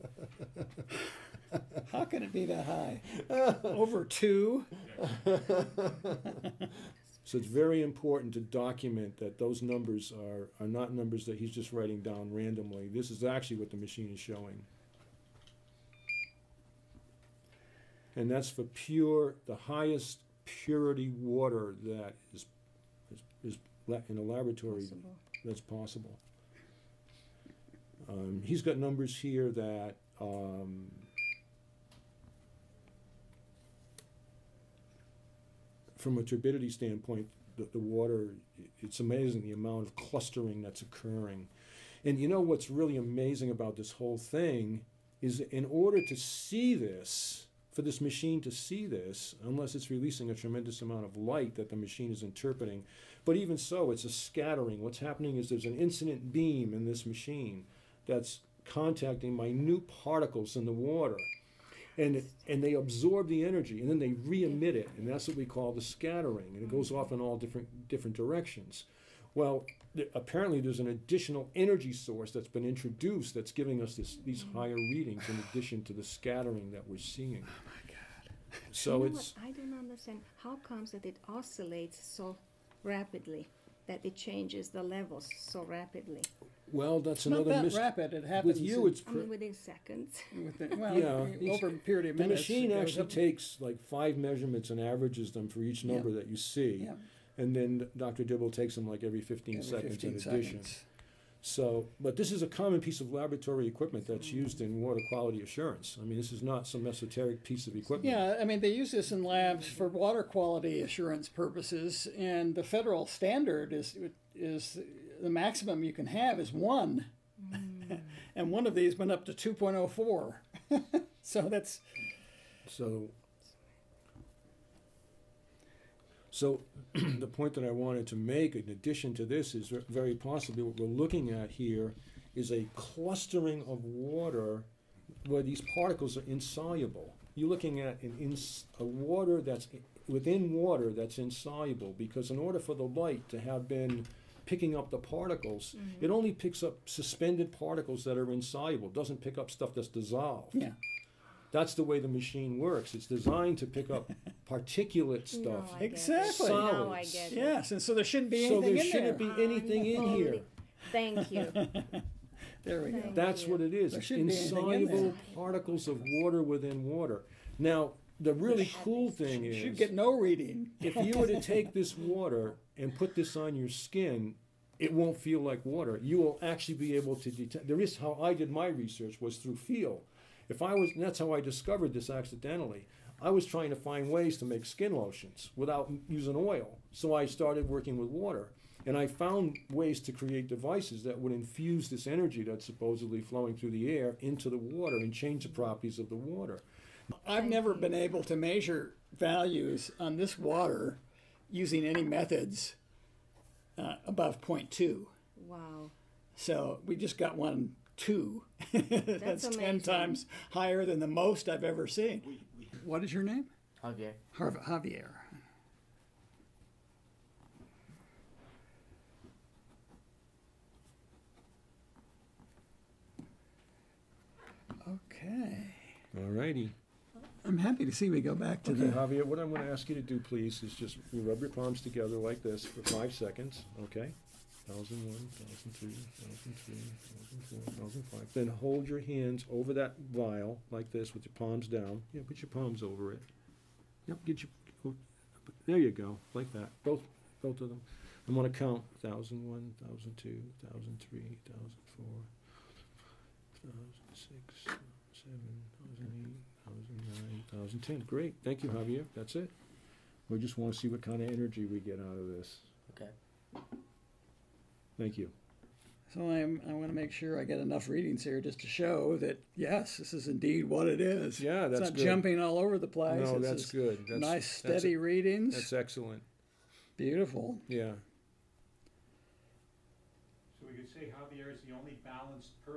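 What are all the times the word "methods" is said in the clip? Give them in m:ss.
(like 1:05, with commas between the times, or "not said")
3:22.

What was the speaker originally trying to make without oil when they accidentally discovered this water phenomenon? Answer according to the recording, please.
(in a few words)
skin lotions.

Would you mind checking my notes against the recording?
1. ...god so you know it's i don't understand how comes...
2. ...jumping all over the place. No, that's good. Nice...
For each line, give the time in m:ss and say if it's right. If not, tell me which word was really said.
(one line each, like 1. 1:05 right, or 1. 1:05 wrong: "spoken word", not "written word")
1. 1:17 right
2. 4:32 right.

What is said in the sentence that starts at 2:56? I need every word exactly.
You will actually be able to detect.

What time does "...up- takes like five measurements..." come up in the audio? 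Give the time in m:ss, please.
1:33.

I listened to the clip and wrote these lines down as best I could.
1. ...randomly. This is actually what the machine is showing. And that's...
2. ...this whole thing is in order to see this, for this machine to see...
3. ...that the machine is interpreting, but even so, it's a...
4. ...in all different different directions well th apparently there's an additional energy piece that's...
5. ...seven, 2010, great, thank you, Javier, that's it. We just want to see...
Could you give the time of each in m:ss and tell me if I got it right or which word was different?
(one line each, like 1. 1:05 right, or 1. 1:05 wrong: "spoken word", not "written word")
1. 0:12 right
2. 0:43 right
3. 0:51 right
4. 1:07 wrong: "source", not "piece"
5. 4:15 right.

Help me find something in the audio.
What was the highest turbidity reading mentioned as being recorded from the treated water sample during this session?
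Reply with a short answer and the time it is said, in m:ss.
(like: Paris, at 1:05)
2.04, at 1:59.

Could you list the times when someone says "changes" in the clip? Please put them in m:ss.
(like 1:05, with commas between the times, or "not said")
1:24, 3:15.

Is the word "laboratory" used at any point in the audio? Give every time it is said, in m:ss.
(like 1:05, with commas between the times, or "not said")
0:24, 1:43.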